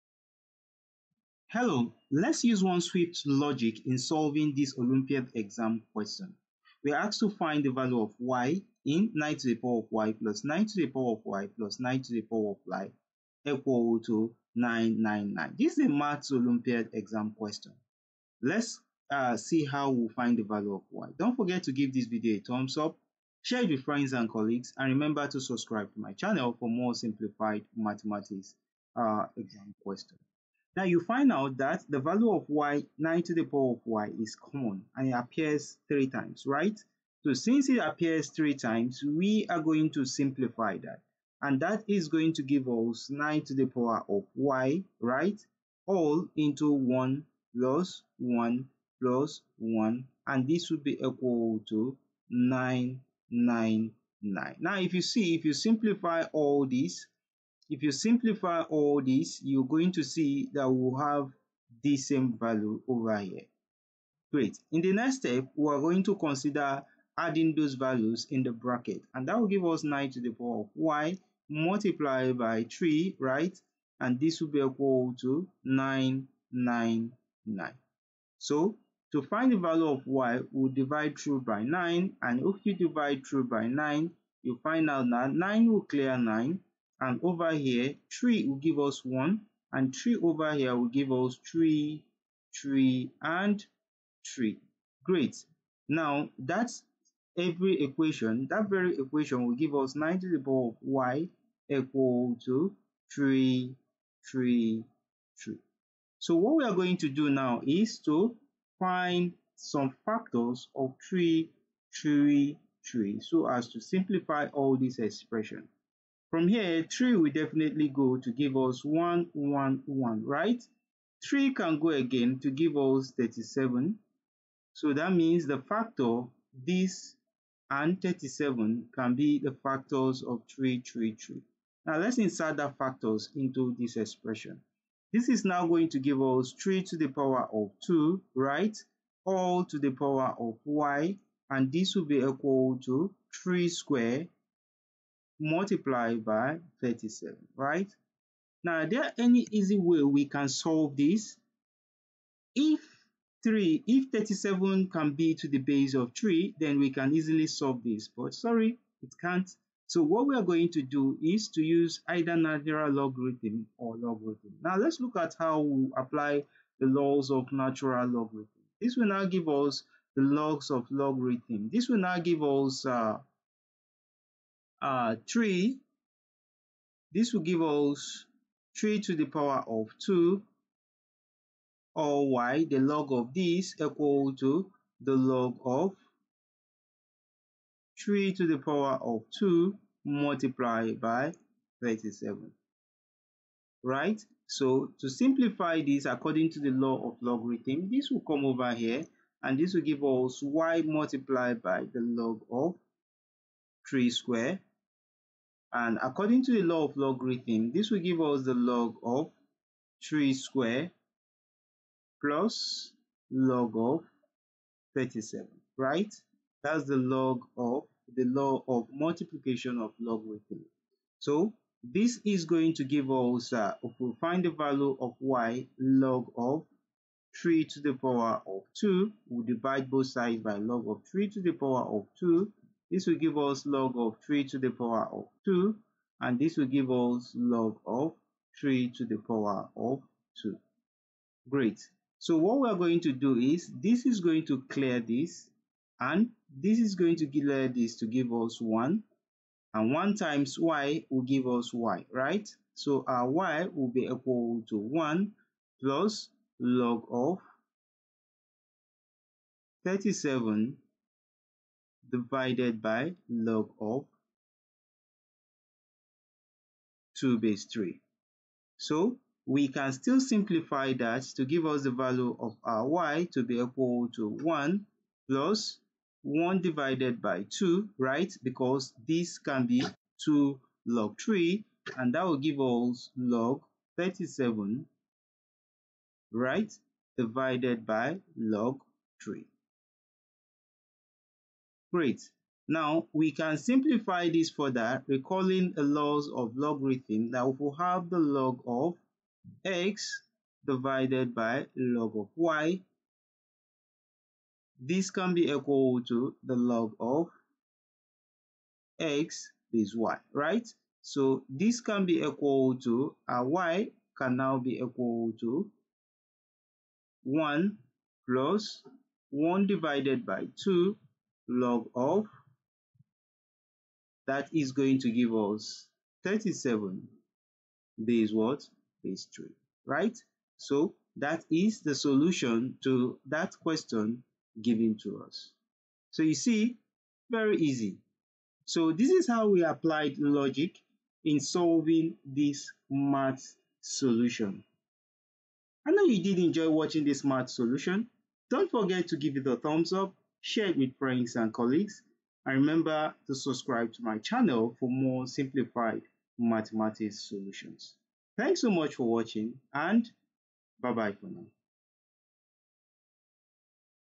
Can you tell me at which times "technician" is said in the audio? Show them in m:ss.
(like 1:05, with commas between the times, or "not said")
not said.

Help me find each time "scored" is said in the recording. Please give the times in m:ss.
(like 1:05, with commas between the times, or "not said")
not said.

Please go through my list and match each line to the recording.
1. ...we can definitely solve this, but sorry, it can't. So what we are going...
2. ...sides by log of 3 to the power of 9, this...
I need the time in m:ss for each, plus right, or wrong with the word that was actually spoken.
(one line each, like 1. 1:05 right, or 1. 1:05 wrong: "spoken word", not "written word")
1. 2:36 wrong: "easily", not "definitely"
2. 3:50 wrong: "2", not "9".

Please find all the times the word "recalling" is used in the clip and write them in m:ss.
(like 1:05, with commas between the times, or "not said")
4:55.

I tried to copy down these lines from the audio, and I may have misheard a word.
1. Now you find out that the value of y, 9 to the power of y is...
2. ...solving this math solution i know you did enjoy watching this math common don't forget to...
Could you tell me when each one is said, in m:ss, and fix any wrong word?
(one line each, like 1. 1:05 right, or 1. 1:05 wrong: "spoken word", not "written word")
1. 0:30 right
2. 5:41 wrong: "solution", not "common".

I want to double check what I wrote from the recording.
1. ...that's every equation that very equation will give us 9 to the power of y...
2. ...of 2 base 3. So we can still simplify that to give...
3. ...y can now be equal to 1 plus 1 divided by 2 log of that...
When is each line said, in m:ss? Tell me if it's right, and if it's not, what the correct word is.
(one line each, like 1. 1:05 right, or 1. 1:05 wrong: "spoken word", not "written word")
1. 1:36 right
2. 4:23 right
3. 5:13 right.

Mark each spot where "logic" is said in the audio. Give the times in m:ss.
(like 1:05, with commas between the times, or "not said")
0:03, 5:40.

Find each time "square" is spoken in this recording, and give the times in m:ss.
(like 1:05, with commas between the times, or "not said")
2:23, 3:24, 3:30.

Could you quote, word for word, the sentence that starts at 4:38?
Because this can be 2 log 3 and that will give us log 37, right?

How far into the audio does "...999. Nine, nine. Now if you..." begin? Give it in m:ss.
0:52.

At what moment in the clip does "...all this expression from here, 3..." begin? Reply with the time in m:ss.
1:54.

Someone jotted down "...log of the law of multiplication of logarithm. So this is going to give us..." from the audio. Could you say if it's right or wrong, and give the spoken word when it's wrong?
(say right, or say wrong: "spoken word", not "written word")
right.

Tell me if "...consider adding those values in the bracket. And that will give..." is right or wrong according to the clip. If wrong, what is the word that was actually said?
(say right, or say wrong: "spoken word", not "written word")
right.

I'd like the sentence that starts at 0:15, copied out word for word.
This is a maths Olympiad exam question.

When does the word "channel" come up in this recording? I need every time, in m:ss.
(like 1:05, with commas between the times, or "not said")
0:26, 5:54.